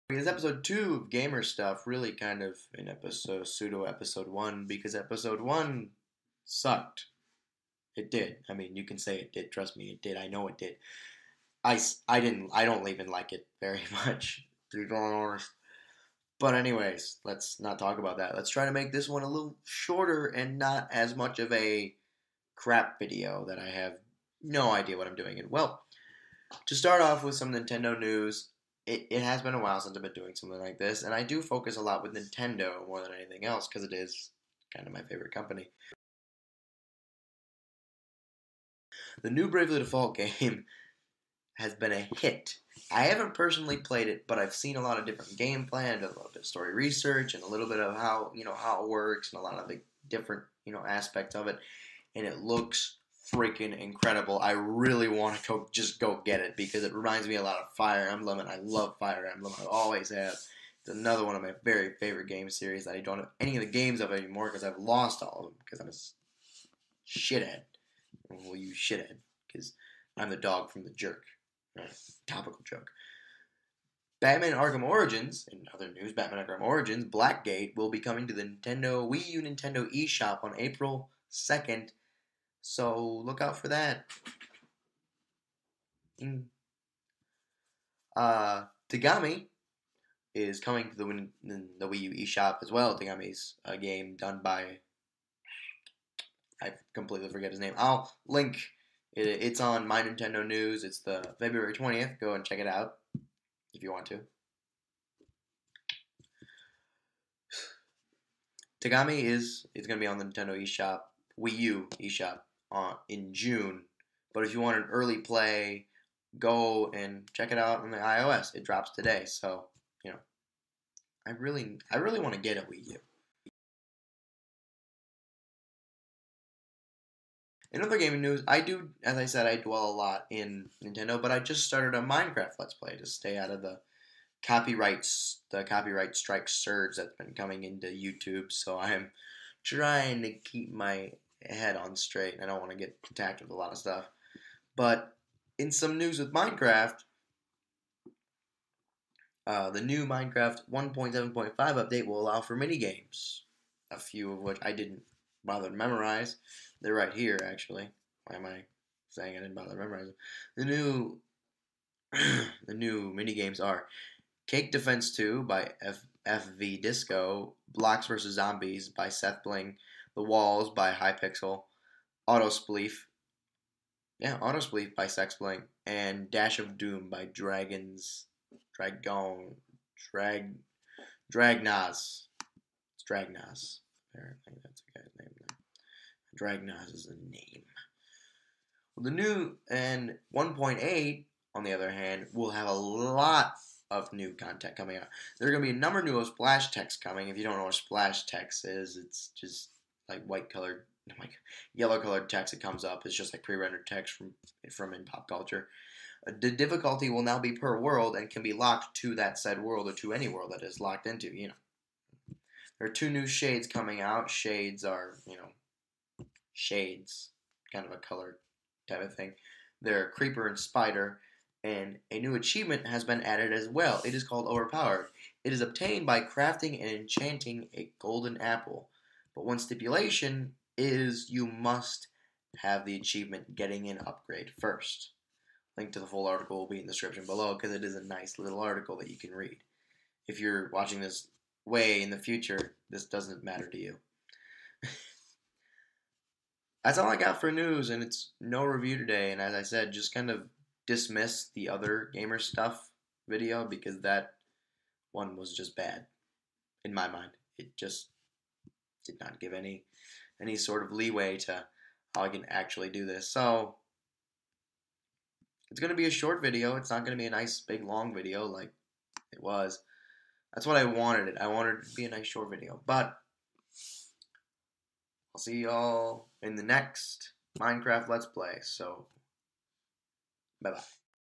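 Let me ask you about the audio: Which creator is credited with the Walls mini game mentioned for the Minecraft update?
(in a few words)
Hypixel.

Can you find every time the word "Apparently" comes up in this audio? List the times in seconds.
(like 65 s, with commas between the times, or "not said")
184 s.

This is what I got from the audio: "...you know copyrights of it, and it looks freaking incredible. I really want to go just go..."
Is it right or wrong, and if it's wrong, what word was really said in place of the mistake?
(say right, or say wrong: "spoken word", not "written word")
wrong: "aspects", not "copyrights".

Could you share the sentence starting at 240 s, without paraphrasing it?
If you're watching this way in the future, this doesn't matter to you.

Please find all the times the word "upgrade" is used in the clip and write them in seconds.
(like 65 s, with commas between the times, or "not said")
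234 s.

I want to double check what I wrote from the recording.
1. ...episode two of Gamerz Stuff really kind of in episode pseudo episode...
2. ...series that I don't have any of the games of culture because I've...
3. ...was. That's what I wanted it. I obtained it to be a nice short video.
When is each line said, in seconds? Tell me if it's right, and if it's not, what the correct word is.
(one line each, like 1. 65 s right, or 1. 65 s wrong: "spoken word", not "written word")
1. 0 s right
2. 62 s wrong: "anymore", not "culture"
3. 269 s wrong: "wanted", not "obtained".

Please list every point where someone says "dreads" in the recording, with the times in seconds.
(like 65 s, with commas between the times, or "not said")
not said.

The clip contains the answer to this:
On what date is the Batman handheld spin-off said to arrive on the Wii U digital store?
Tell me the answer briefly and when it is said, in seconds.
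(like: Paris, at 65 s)
April 2, at 80 s.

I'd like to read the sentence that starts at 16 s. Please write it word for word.
But anyways, let's not talk about that.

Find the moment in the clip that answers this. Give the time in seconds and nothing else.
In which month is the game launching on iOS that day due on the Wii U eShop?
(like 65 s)
113 s.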